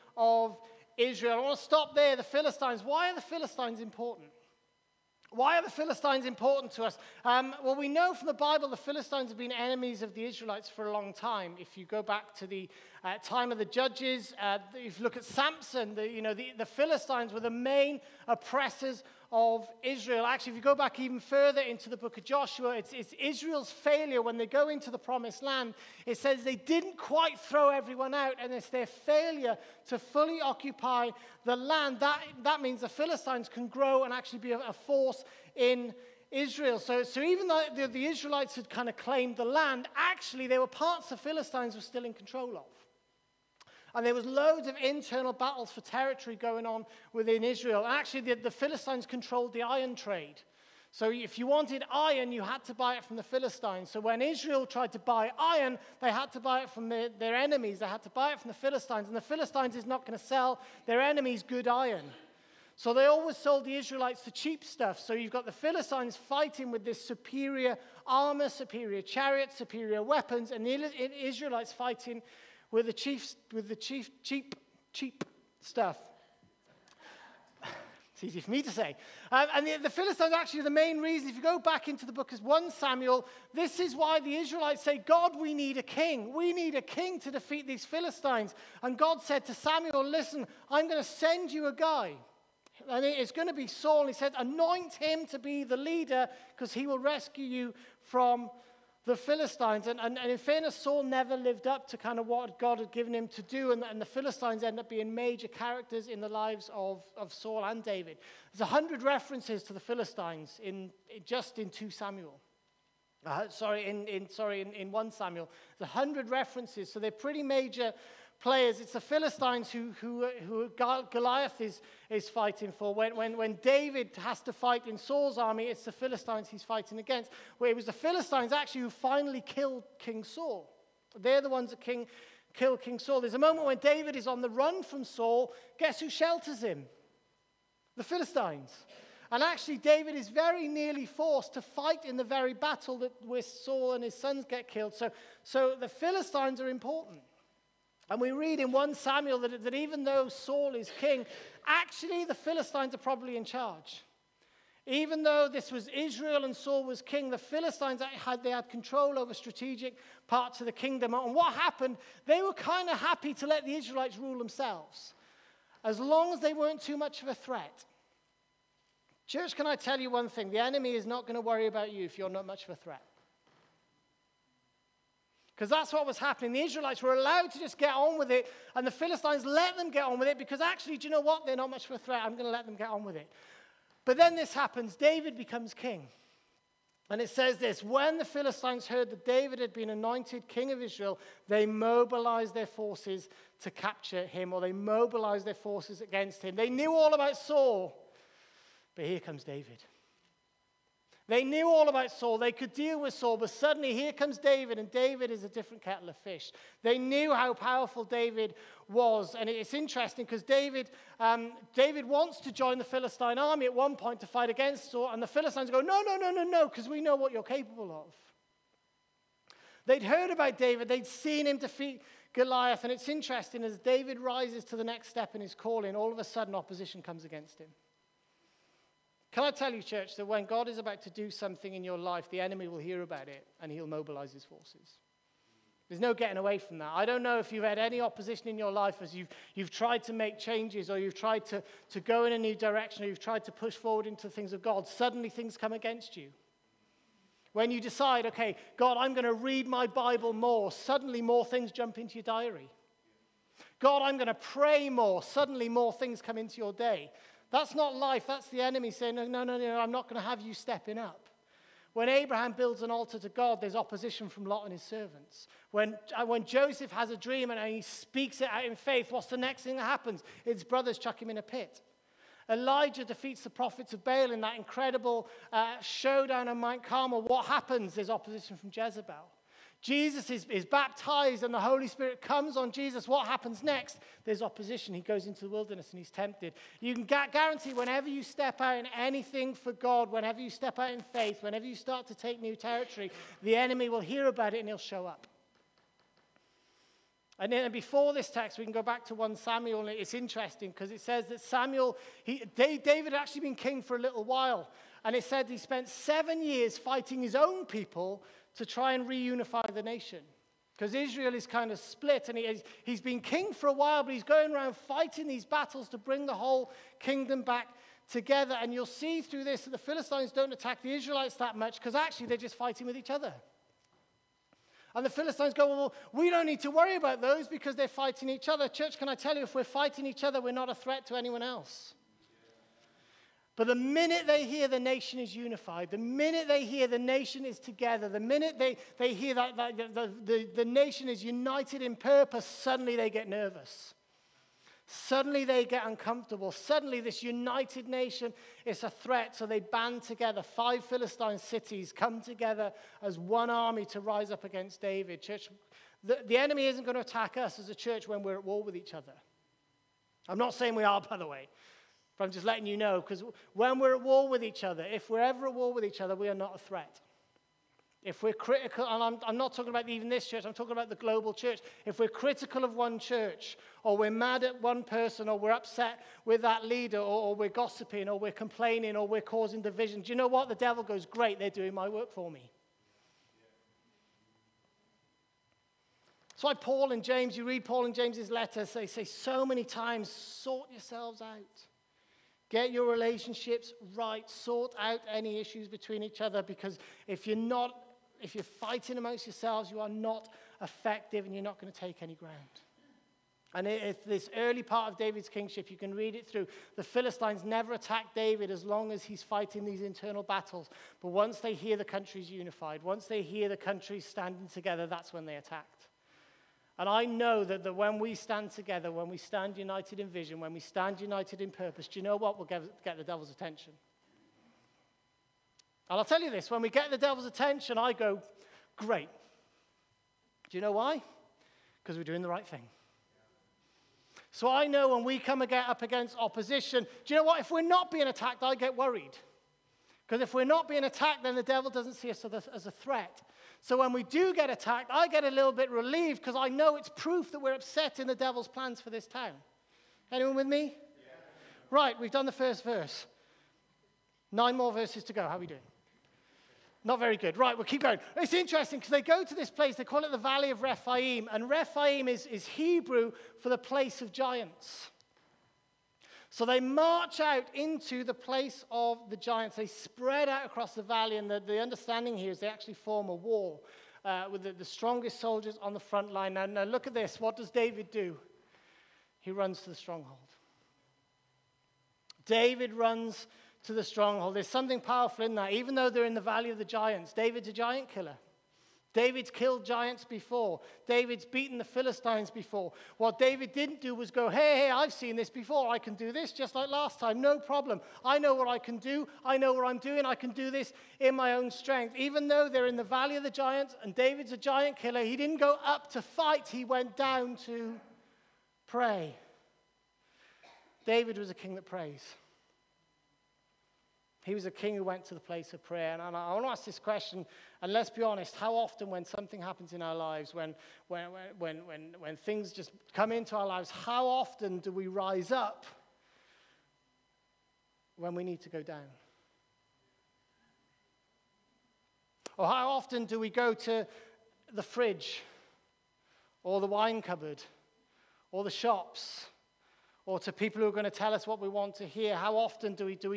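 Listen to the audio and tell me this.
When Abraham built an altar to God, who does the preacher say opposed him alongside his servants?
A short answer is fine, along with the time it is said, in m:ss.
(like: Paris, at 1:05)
Lot, at 4:24.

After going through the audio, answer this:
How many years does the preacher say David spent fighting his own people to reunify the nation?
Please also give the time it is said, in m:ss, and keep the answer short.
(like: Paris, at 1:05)
7, at 5:05.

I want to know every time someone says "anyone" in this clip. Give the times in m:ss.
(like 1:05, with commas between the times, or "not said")
5:31, 7:30.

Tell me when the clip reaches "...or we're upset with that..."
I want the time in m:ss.
6:15.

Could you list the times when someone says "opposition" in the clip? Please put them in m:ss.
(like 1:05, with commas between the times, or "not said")
3:46, 3:58, 4:23, 4:38, 4:44, 7:16.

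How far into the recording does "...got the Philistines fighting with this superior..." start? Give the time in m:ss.
1:05.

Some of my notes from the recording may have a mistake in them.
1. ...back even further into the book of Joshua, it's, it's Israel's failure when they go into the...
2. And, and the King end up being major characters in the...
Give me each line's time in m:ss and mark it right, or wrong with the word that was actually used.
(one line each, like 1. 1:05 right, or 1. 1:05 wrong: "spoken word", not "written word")
1. 0:20 right
2. 1:43 wrong: "Philistines", not "King".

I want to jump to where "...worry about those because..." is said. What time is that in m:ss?
5:26.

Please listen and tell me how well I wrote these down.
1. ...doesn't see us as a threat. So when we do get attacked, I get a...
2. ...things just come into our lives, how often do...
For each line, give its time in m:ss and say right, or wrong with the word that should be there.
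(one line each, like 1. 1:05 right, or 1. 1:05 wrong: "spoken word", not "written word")
1. 7:21 right
2. 8:42 right.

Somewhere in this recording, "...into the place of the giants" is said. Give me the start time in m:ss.
7:47.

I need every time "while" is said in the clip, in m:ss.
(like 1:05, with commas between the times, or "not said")
5:04, 5:13.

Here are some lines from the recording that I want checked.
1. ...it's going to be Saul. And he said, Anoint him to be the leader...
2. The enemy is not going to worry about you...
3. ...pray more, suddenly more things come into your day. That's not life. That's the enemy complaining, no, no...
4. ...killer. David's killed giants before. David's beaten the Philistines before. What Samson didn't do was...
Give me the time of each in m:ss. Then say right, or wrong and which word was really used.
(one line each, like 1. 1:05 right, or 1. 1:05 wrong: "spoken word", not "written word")
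1. 1:33 right
2. 2:50 right
3. 4:14 wrong: "saying", not "complaining"
4. 8:07 wrong: "David", not "Samson".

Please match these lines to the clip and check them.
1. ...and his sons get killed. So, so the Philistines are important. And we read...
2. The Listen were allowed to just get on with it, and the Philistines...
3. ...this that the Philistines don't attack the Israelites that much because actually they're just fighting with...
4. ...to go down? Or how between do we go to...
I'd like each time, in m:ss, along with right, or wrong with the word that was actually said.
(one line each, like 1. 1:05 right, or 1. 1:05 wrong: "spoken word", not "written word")
1. 2:23 right
2. 2:56 wrong: "Israelites", not "Listen"
3. 5:19 right
4. 8:48 wrong: "often", not "between".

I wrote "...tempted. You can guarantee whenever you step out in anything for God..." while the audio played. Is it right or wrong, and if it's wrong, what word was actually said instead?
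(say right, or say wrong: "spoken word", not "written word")
right.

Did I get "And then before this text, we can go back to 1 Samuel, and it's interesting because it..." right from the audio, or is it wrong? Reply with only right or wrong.
right.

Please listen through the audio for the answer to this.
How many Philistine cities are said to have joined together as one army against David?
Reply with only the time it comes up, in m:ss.
5:50.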